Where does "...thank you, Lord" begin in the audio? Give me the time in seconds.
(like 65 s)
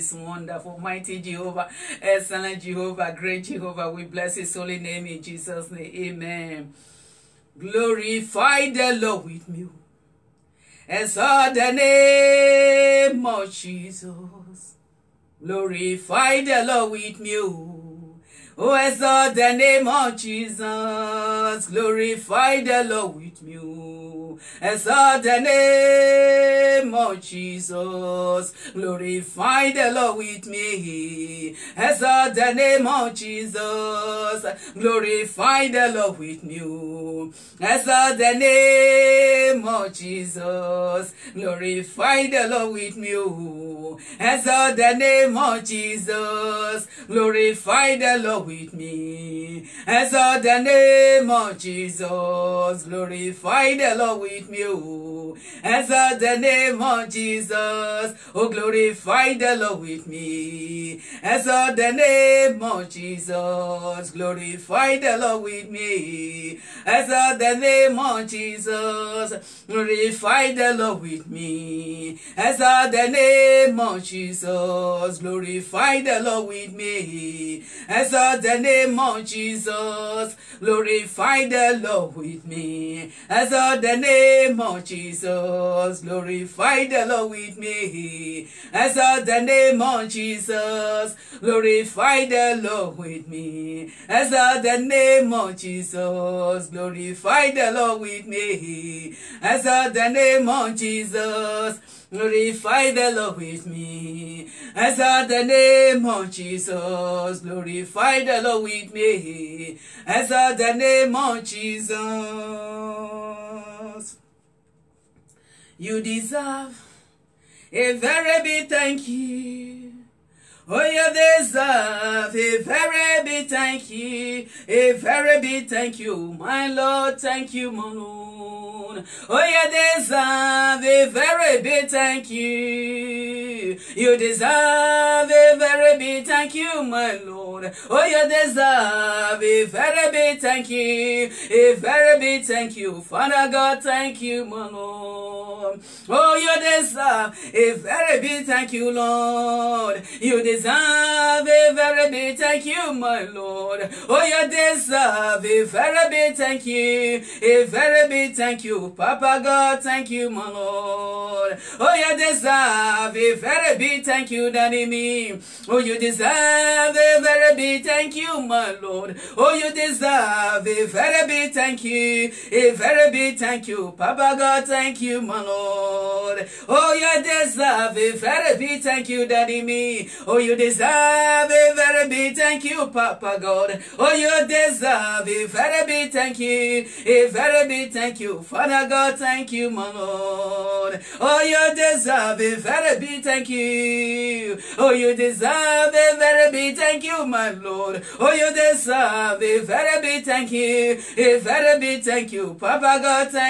148 s.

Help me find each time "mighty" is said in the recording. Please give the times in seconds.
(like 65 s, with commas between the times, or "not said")
0 s.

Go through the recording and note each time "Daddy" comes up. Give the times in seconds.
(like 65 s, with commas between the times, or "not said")
164 s, 179 s.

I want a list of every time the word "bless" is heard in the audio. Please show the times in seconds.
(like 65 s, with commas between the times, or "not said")
4 s.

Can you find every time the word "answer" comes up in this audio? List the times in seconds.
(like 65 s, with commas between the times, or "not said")
55 s, 61 s, 66 s, 72 s, 77 s, 83 s.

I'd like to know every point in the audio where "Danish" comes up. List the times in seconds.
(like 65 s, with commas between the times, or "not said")
not said.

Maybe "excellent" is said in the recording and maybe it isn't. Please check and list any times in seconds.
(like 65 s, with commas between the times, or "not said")
2 s.